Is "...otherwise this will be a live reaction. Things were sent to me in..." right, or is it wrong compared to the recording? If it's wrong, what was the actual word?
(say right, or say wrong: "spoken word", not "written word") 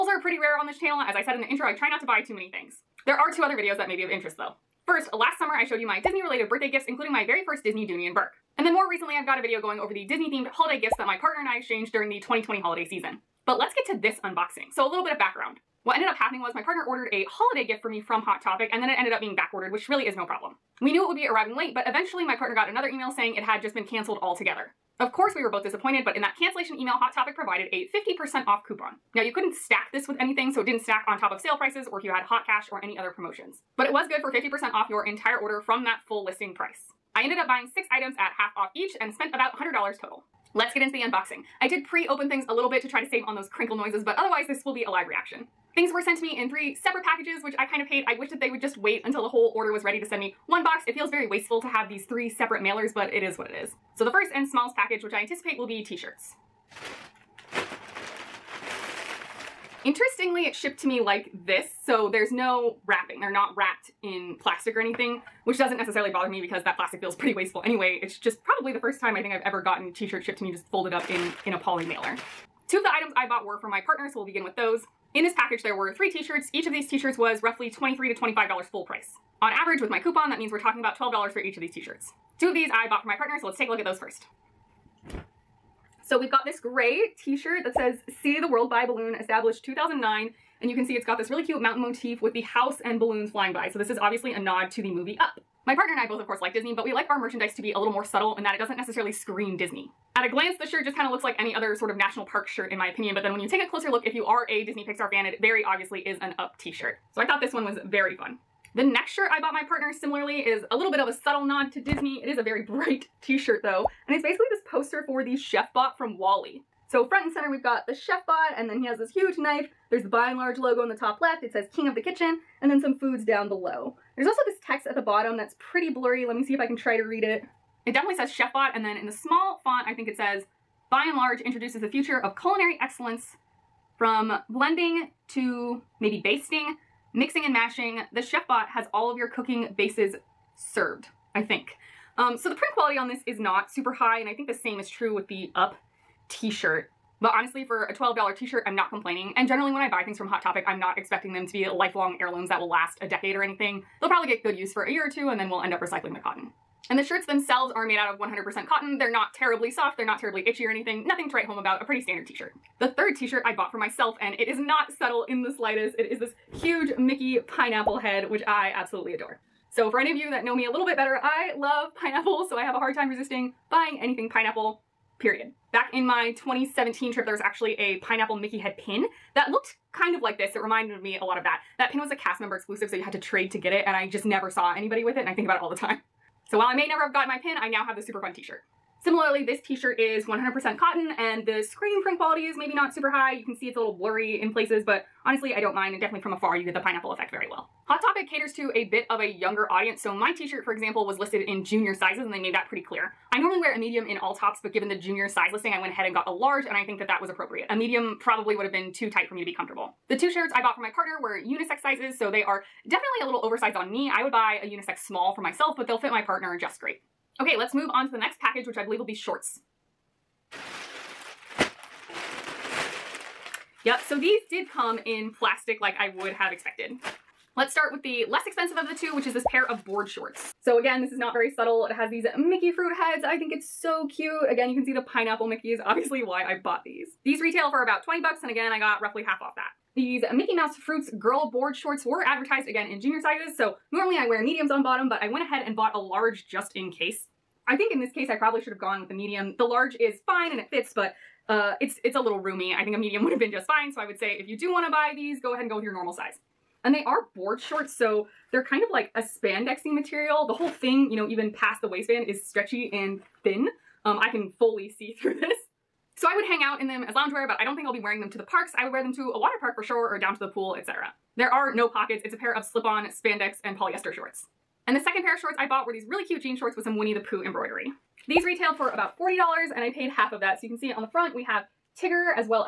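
right.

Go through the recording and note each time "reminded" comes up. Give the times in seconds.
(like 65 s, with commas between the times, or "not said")
180 s.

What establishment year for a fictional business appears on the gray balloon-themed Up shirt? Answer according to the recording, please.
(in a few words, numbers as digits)
2009.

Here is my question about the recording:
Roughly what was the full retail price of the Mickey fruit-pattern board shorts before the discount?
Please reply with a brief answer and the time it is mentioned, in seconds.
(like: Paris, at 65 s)
$20, at 238 s.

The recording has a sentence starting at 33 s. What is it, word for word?
But it was good for 50% off your entire order from that full listing price.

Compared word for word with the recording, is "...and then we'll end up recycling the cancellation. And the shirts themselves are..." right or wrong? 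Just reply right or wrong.
wrong.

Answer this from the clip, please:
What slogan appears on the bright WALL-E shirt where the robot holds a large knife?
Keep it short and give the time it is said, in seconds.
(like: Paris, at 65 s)
King of the kitchen, at 121 s.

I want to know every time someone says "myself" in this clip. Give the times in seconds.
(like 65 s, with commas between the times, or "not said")
163 s, 215 s.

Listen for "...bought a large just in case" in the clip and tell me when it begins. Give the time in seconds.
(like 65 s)
245 s.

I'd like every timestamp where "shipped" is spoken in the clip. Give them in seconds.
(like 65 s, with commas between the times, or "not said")
60 s, 70 s.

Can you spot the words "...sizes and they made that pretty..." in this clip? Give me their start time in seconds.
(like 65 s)
201 s.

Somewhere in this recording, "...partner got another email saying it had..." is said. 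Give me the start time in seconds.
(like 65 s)
22 s.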